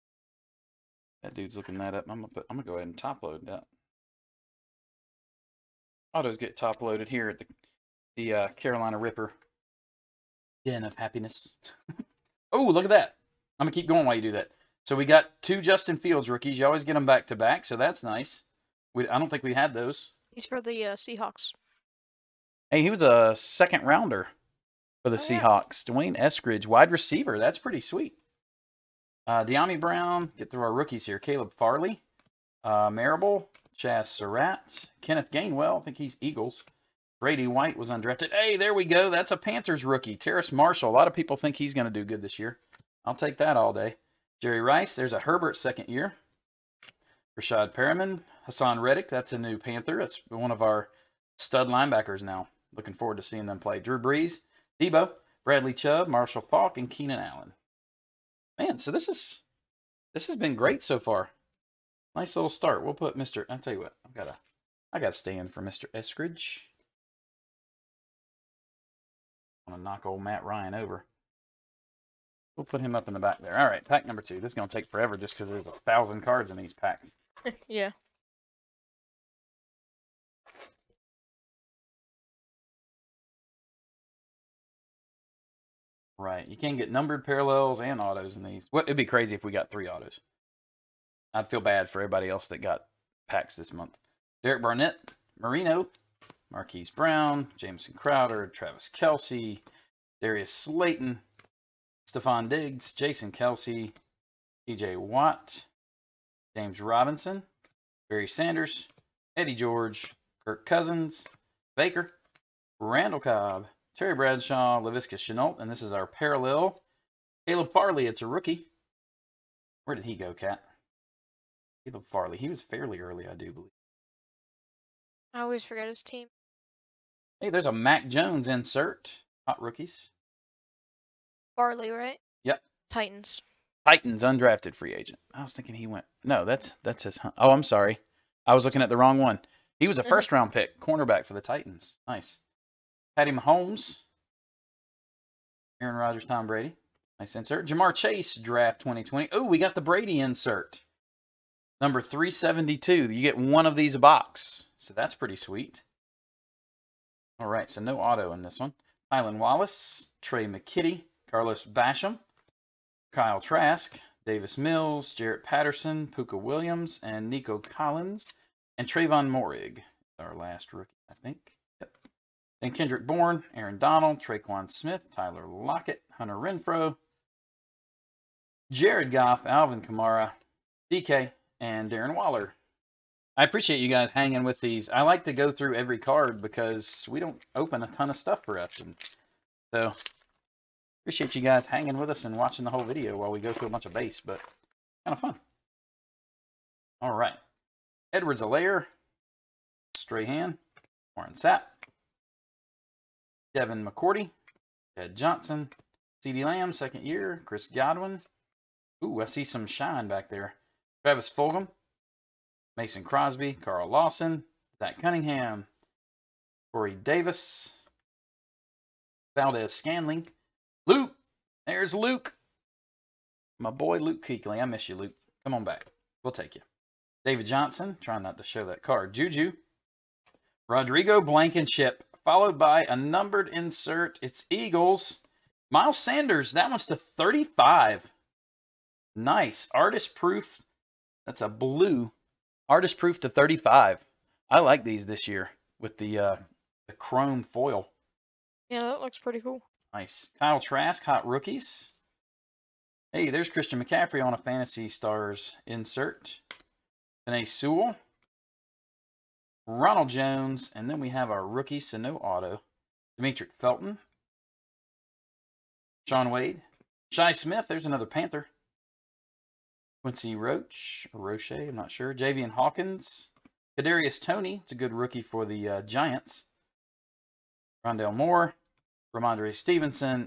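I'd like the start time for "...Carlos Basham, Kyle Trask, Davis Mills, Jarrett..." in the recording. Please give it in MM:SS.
02:41.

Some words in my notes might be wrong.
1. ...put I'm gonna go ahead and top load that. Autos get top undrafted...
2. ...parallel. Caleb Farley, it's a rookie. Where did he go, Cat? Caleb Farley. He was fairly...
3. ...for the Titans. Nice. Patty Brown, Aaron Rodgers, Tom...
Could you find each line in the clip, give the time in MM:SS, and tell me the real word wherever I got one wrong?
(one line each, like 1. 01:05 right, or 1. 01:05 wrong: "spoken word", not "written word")
1. 00:02 wrong: "loaded", not "undrafted"
2. 01:56 right
3. 02:21 wrong: "Mahomes", not "Brown".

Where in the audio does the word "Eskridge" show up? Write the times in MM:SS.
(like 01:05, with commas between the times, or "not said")
00:26, 01:05.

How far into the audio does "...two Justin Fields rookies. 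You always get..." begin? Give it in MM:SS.
00:15.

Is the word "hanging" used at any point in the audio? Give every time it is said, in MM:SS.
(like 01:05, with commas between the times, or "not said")
03:04, 03:11.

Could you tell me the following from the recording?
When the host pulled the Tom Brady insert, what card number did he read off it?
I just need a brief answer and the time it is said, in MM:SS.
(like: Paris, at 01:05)
372, at 02:32.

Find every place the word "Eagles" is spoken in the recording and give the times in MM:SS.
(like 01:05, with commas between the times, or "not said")
00:36, 03:54.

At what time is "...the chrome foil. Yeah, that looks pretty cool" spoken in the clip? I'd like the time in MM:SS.
04:06.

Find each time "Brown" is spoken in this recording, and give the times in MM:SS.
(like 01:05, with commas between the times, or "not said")
00:29, 01:36.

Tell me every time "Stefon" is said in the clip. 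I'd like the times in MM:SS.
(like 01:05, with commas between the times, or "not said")
01:42.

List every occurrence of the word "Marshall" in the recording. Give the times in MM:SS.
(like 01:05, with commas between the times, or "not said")
00:40, 00:56.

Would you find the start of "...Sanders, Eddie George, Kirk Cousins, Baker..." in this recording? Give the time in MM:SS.
01:48.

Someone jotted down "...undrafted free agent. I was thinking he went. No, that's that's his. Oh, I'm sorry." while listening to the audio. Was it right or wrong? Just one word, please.
right.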